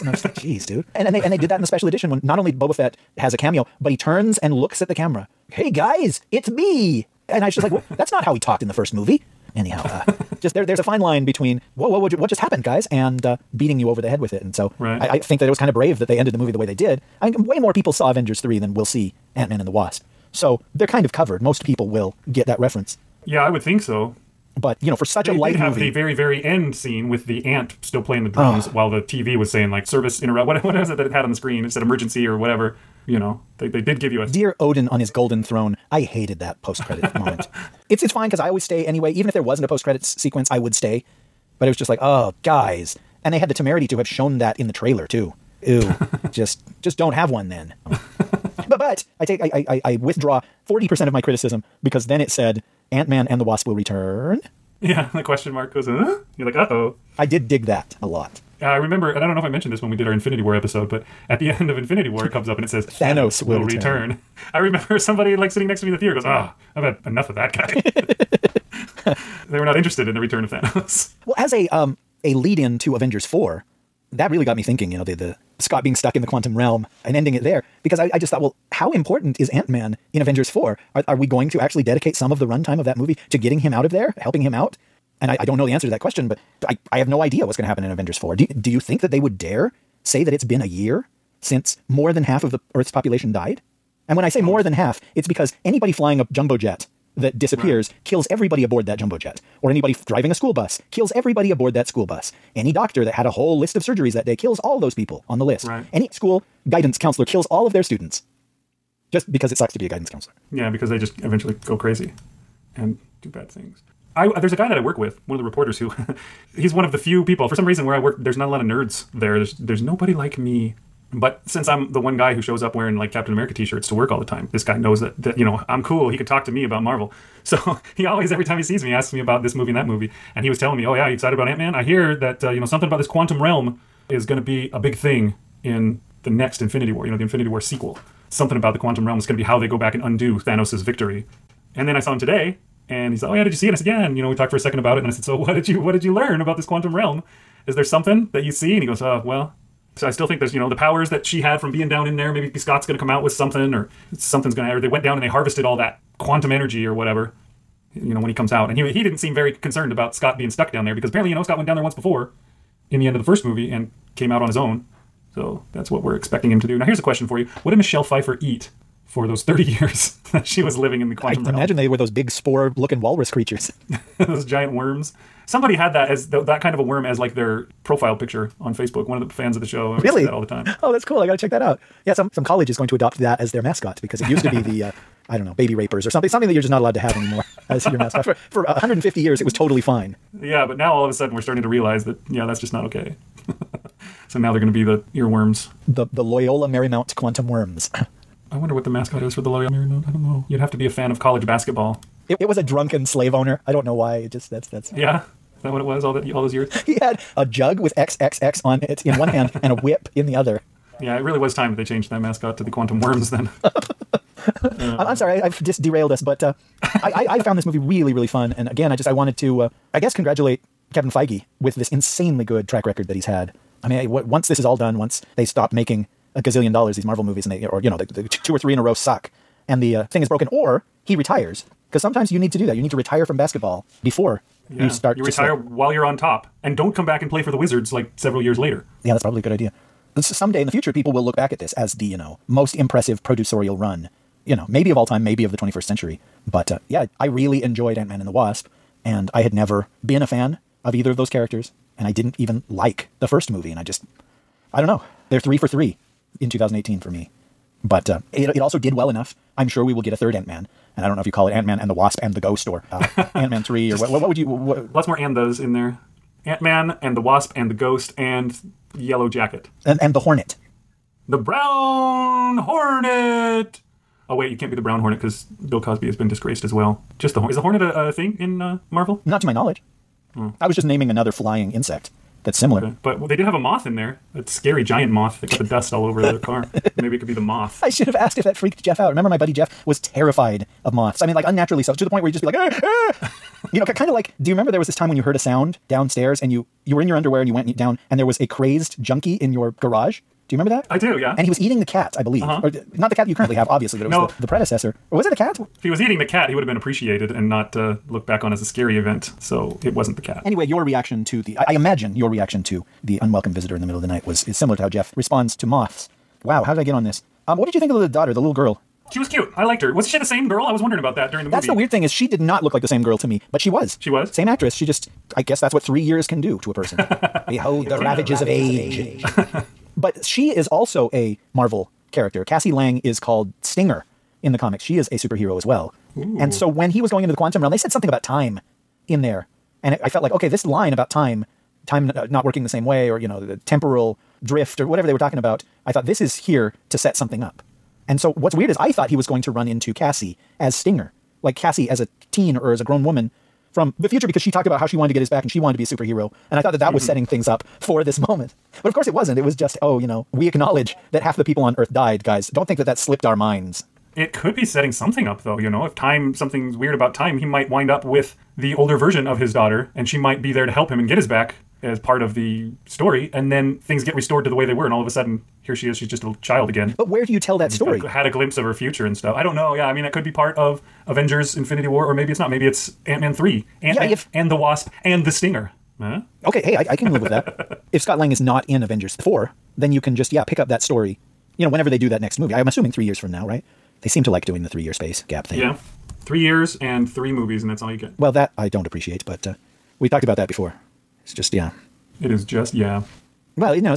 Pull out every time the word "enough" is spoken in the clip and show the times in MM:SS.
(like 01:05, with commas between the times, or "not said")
01:07, 04:19.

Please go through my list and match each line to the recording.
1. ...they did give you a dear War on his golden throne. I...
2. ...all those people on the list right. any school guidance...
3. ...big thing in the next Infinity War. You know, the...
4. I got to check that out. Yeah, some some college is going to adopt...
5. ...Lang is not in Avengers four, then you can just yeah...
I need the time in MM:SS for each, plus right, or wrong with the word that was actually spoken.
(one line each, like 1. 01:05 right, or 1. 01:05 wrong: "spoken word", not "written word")
1. 00:33 wrong: "Odin", not "War"
2. 01:44 right
3. 02:14 right
4. 03:01 right
5. 06:28 right.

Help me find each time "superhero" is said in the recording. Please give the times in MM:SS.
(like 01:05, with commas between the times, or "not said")
05:35, 05:55.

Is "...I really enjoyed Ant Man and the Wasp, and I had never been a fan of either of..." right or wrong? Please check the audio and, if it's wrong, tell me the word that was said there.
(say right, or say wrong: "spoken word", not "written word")
right.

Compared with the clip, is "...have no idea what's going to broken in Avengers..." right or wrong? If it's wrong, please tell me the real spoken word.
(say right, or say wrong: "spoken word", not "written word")
wrong: "happen", not "broken".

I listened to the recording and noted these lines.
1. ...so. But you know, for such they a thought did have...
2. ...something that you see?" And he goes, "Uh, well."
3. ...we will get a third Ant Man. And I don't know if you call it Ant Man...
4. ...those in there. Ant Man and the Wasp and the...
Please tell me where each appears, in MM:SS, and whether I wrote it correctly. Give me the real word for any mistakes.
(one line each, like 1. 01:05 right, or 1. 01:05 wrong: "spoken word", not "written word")
1. 00:23 wrong: "light", not "thought"
2. 02:27 right
3. 04:19 right
4. 04:25 right.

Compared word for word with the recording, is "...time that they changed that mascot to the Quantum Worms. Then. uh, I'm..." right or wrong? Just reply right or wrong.
right.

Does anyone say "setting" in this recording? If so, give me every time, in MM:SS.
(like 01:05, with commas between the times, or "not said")
05:57, 06:04.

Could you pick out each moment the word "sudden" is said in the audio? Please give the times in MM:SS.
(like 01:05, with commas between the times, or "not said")
03:11, 06:15.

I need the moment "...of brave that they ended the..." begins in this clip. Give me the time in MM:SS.
00:15.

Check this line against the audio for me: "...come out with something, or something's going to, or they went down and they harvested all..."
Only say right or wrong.
right.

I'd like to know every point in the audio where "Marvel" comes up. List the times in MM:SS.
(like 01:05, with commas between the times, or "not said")
02:06, 03:47, 04:38, 05:31.